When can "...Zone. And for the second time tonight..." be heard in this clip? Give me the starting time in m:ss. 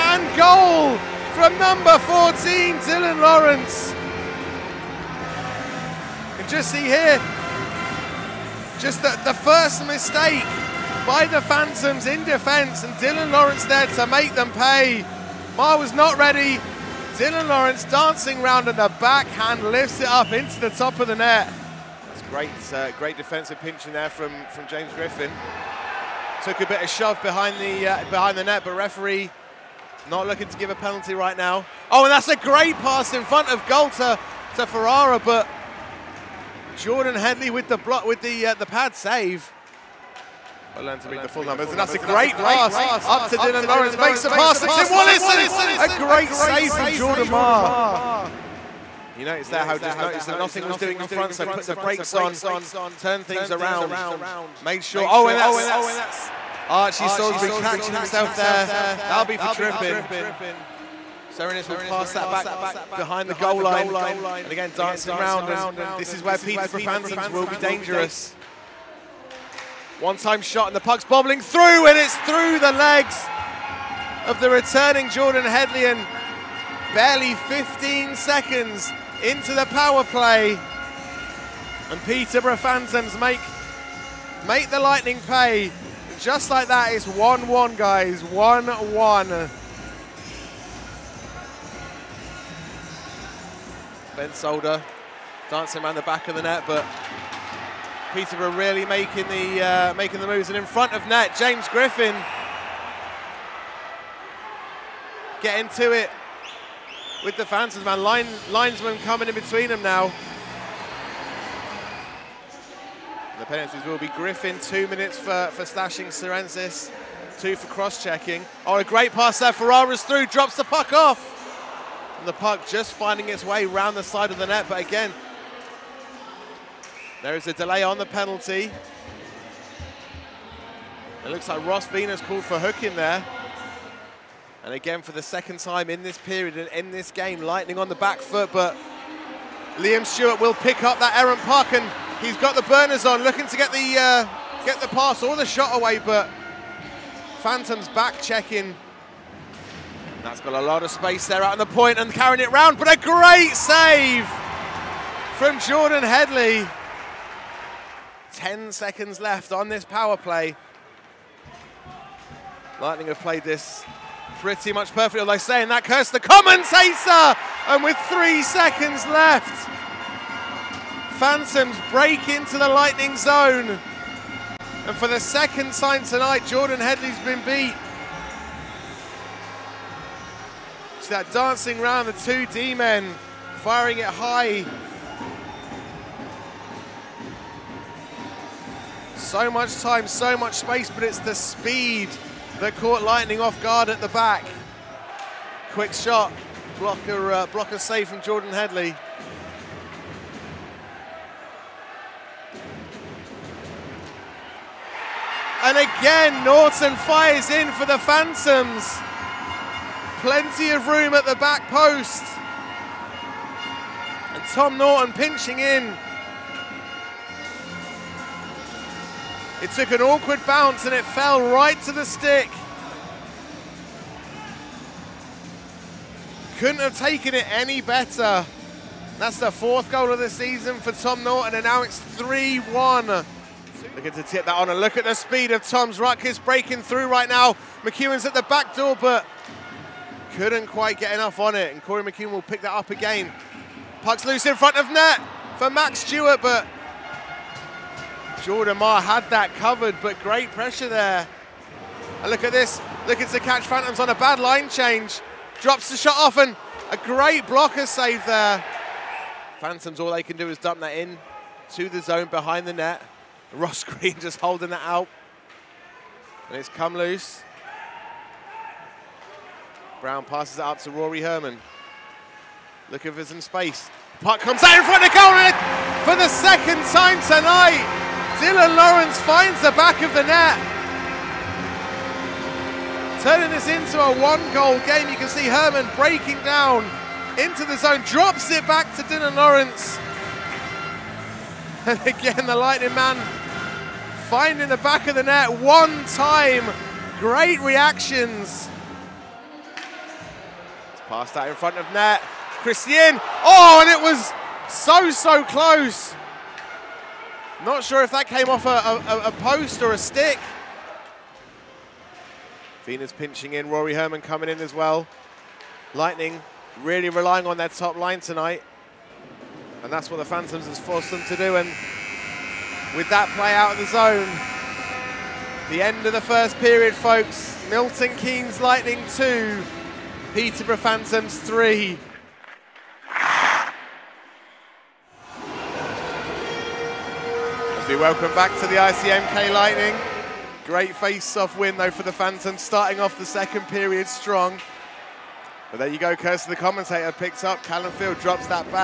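2:53.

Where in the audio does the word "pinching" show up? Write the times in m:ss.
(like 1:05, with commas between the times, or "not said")
0:23, 3:35, 5:13.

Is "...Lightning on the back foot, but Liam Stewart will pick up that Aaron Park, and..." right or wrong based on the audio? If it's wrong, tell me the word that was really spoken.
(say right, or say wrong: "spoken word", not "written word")
right.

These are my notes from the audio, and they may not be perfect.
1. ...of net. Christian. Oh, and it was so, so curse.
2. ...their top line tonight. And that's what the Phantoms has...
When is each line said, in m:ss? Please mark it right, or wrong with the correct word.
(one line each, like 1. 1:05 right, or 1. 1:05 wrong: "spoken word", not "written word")
1. 5:01 wrong: "close", not "curse"
2. 5:17 right.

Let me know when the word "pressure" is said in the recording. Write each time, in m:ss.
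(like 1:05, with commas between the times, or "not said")
4:10.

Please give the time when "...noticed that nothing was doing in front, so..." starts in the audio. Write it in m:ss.
0:49.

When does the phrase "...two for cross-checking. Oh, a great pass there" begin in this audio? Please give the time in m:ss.
1:57.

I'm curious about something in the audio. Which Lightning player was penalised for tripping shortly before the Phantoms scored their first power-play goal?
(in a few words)
Archie Salisbury.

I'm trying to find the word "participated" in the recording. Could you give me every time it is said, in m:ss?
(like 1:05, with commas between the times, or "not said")
not said.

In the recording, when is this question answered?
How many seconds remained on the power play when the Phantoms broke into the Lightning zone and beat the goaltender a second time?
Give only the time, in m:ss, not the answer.
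2:48.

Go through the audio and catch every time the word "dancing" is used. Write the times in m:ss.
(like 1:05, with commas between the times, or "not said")
0:17, 1:04, 1:35, 3:01.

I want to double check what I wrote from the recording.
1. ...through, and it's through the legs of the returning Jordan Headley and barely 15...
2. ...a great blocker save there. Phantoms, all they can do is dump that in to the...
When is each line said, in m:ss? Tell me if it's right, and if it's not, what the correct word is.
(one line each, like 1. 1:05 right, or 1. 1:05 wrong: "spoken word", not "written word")
1. 1:11 right
2. 4:16 right.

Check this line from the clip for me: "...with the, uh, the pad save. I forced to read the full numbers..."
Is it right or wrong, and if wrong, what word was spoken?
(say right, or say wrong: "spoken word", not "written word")
wrong: "learned", not "forced".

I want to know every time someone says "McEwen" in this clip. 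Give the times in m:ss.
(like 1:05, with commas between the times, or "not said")
3:57, 4:02.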